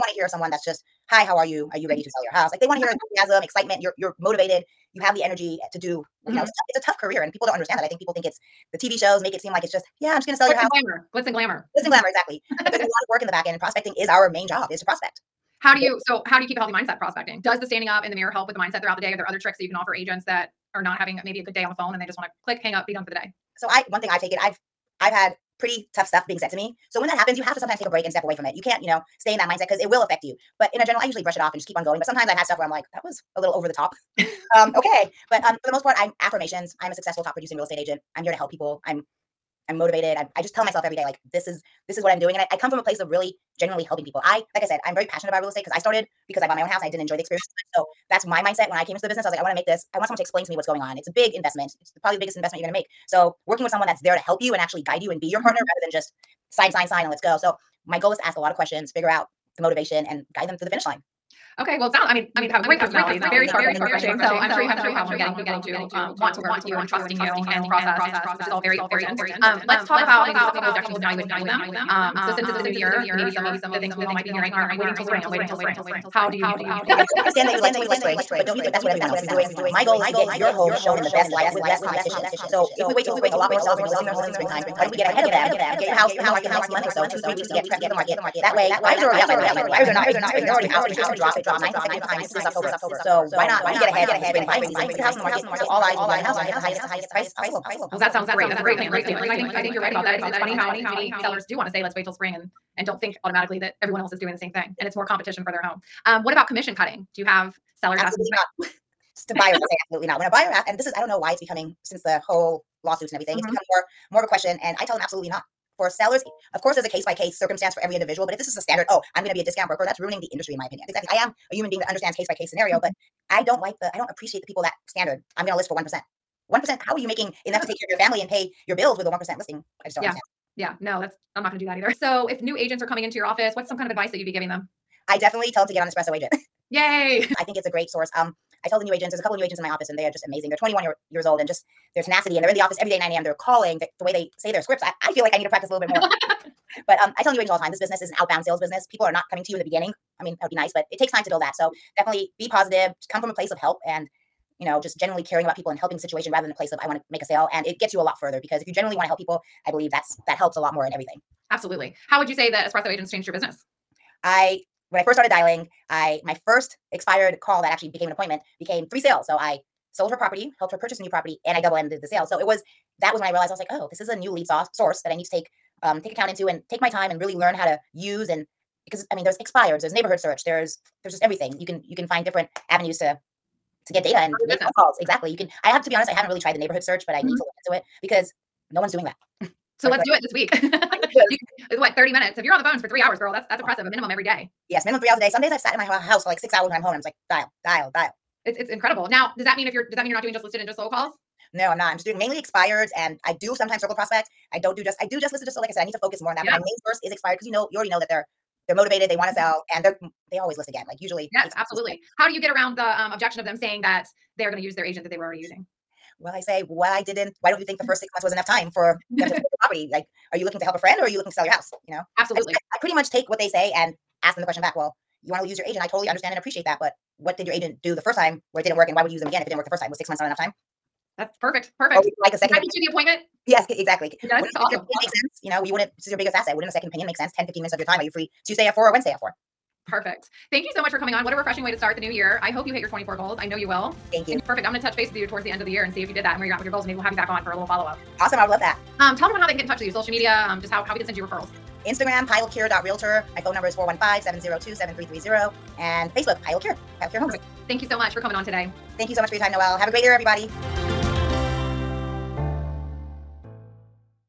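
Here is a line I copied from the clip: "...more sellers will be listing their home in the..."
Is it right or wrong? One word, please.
right.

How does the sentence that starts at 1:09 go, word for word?
Um, let's talk about maybe just a couple objections and how you would handle them.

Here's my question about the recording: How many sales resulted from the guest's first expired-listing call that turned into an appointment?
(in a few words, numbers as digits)
3.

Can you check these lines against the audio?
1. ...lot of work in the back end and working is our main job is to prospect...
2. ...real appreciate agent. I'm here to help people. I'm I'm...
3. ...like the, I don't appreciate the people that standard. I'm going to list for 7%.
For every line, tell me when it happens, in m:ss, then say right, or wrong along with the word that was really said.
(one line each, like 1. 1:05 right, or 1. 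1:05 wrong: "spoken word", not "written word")
1. 0:12 wrong: "prospecting", not "working"
2. 0:37 wrong: "estate", not "appreciate"
3. 2:03 wrong: "1", not "7".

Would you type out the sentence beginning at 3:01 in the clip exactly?
You can you can find different avenues to to get data and make phone calls.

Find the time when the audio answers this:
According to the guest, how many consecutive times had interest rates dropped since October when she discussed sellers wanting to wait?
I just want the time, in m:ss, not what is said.
1:31.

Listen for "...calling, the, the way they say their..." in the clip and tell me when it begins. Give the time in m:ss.
2:23.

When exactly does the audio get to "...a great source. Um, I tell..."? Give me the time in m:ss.
2:17.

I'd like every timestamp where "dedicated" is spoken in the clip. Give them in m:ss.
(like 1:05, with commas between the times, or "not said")
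not said.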